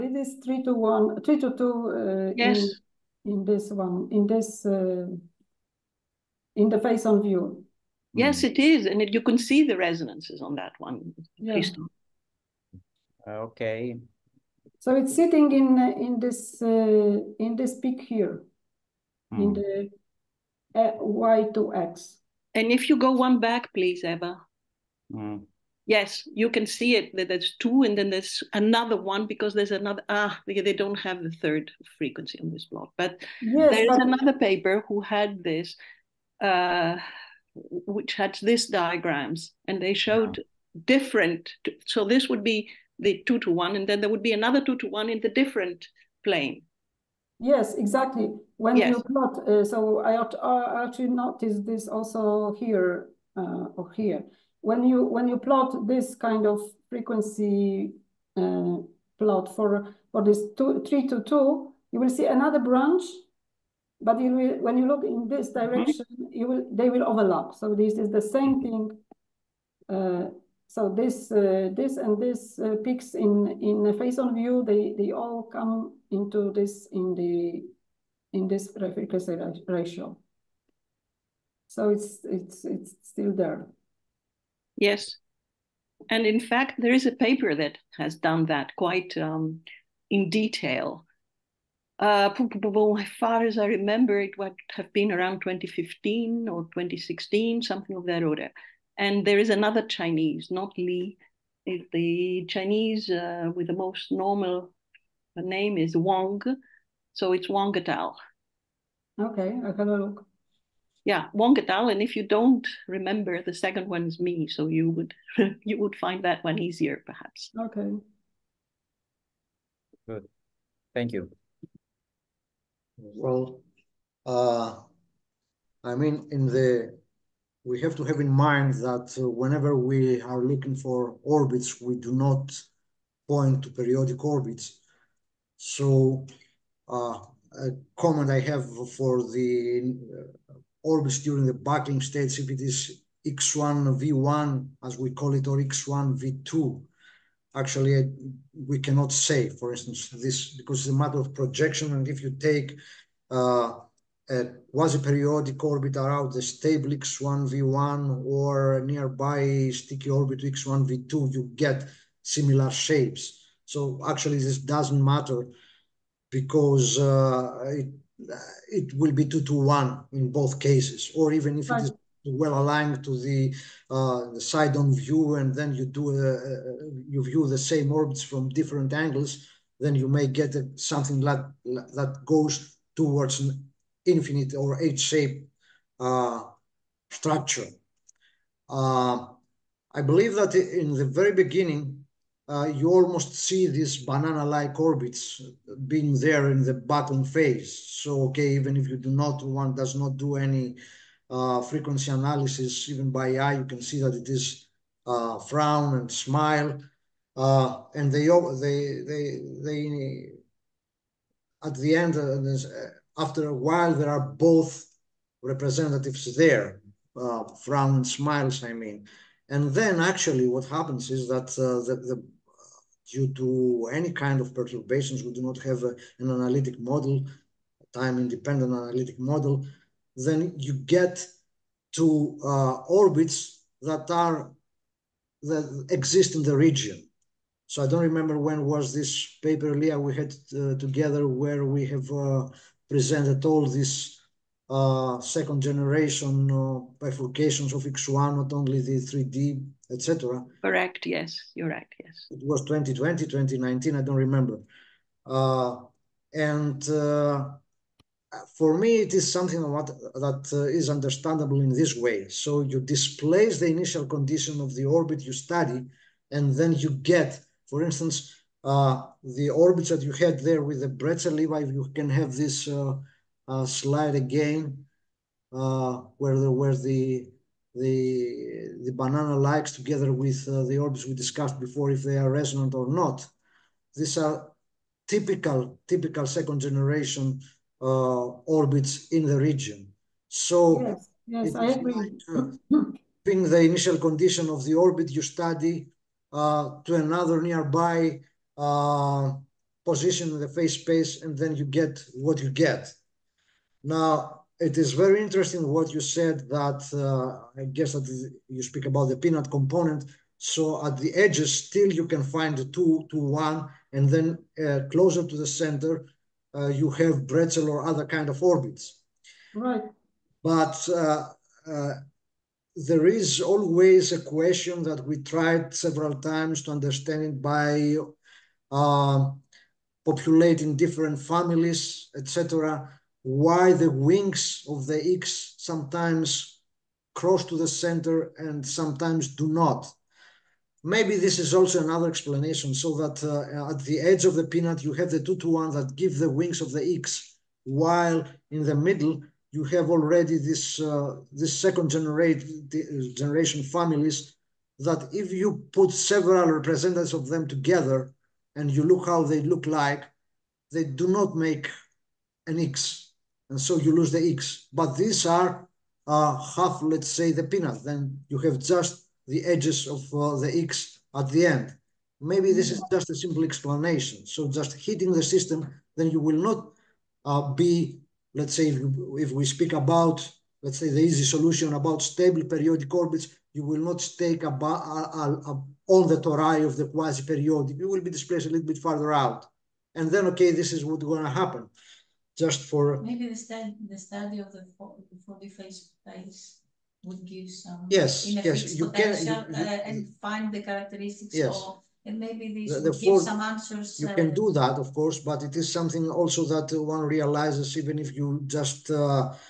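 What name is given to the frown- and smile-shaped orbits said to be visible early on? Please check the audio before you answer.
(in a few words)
banana-like orbits.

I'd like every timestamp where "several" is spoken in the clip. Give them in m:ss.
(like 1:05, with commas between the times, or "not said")
5:25, 5:55.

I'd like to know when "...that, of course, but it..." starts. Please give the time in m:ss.
6:44.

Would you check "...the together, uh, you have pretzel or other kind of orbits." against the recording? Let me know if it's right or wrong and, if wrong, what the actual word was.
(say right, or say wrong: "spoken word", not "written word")
wrong: "center", not "together".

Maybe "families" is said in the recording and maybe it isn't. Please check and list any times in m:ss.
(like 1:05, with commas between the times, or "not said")
5:31, 5:53.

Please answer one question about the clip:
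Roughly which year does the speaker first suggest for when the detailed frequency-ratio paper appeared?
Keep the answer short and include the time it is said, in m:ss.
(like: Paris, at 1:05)
2015, at 1:35.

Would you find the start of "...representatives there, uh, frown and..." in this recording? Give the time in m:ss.
3:35.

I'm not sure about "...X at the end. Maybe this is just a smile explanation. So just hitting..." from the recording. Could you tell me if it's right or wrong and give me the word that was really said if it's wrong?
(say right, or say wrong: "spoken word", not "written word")
wrong: "simple", not "smile".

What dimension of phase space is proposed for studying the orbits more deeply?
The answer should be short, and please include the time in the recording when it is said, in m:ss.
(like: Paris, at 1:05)
4, at 6:35.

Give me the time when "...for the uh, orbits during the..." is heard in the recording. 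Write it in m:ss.
2:18.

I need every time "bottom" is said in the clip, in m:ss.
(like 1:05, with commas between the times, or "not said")
3:16.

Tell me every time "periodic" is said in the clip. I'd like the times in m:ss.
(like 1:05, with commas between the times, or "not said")
2:13, 2:34, 6:22, 6:26.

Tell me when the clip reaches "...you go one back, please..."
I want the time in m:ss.
0:22.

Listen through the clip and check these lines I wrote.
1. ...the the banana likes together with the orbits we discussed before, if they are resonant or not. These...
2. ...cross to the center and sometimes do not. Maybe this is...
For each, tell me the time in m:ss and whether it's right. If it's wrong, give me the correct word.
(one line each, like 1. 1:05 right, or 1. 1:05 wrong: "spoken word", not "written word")
1. 4:37 right
2. 5:37 right.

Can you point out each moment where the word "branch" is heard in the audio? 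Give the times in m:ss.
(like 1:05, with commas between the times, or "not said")
1:02.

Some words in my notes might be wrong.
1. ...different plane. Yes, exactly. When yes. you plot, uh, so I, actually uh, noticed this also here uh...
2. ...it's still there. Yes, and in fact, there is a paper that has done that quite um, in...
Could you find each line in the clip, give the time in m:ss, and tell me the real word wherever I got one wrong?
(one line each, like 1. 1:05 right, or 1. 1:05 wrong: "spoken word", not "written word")
1. 0:45 right
2. 1:22 right.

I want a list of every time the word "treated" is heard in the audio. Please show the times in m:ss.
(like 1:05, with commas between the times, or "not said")
not said.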